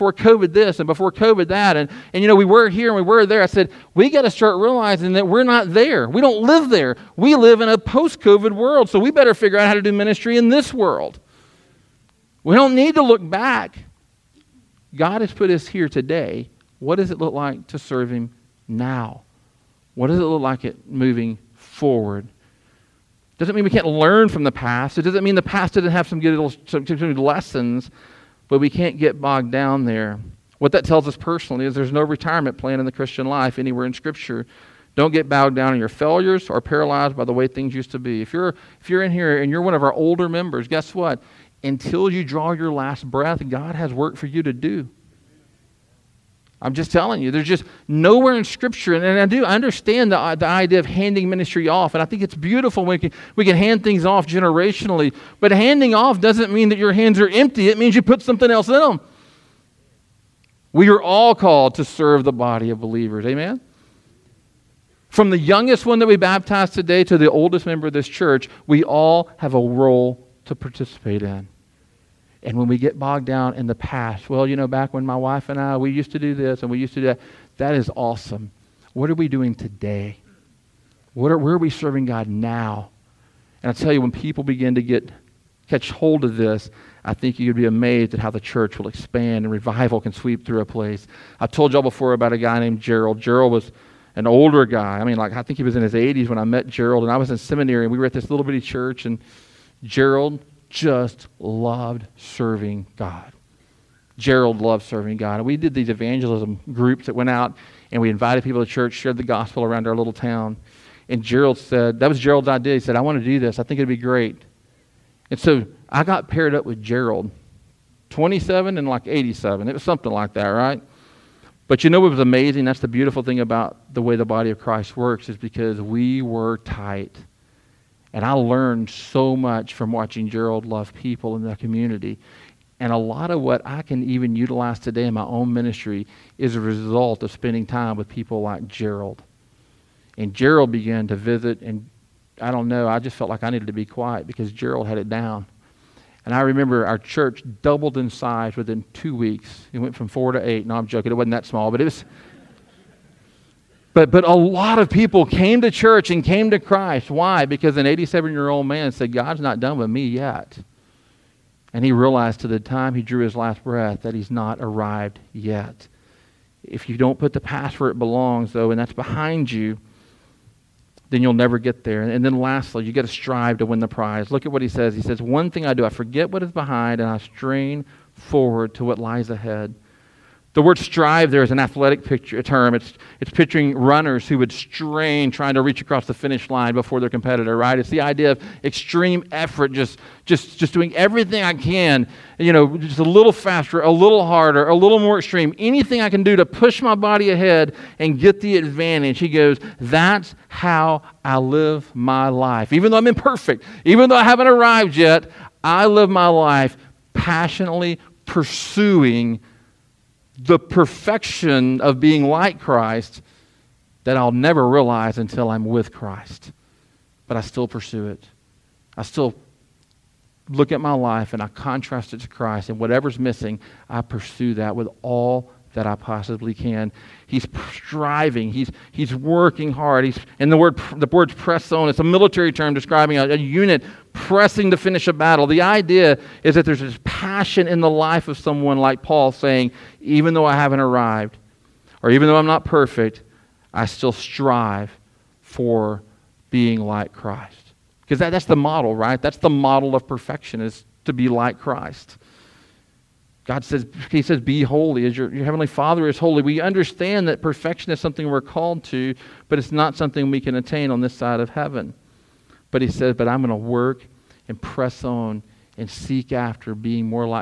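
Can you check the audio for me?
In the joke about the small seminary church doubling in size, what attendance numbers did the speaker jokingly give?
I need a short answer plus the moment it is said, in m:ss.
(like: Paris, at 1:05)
4 to 8, at 2:30.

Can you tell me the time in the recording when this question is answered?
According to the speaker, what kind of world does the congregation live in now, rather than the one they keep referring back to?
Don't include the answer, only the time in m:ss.
0:07.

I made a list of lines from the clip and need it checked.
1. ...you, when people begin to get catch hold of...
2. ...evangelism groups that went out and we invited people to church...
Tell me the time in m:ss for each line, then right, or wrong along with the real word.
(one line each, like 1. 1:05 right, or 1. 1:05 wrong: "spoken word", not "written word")
1. 1:23 right
2. 1:45 right.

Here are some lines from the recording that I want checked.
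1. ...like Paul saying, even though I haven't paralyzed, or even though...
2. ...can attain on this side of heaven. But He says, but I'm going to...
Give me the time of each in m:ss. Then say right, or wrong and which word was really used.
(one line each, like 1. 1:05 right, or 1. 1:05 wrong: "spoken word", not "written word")
1. 3:58 wrong: "arrived", not "paralyzed"
2. 4:20 right.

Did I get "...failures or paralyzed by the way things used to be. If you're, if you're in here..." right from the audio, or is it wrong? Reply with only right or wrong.
right.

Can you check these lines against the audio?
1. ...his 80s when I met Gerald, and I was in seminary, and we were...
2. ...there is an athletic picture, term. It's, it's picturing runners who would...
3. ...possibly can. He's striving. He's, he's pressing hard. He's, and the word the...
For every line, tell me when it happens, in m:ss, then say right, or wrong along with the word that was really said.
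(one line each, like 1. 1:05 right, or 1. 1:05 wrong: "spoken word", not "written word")
1. 1:35 right
2. 3:01 right
3. 3:45 wrong: "working", not "pressing".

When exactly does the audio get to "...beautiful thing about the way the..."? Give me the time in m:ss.
2:02.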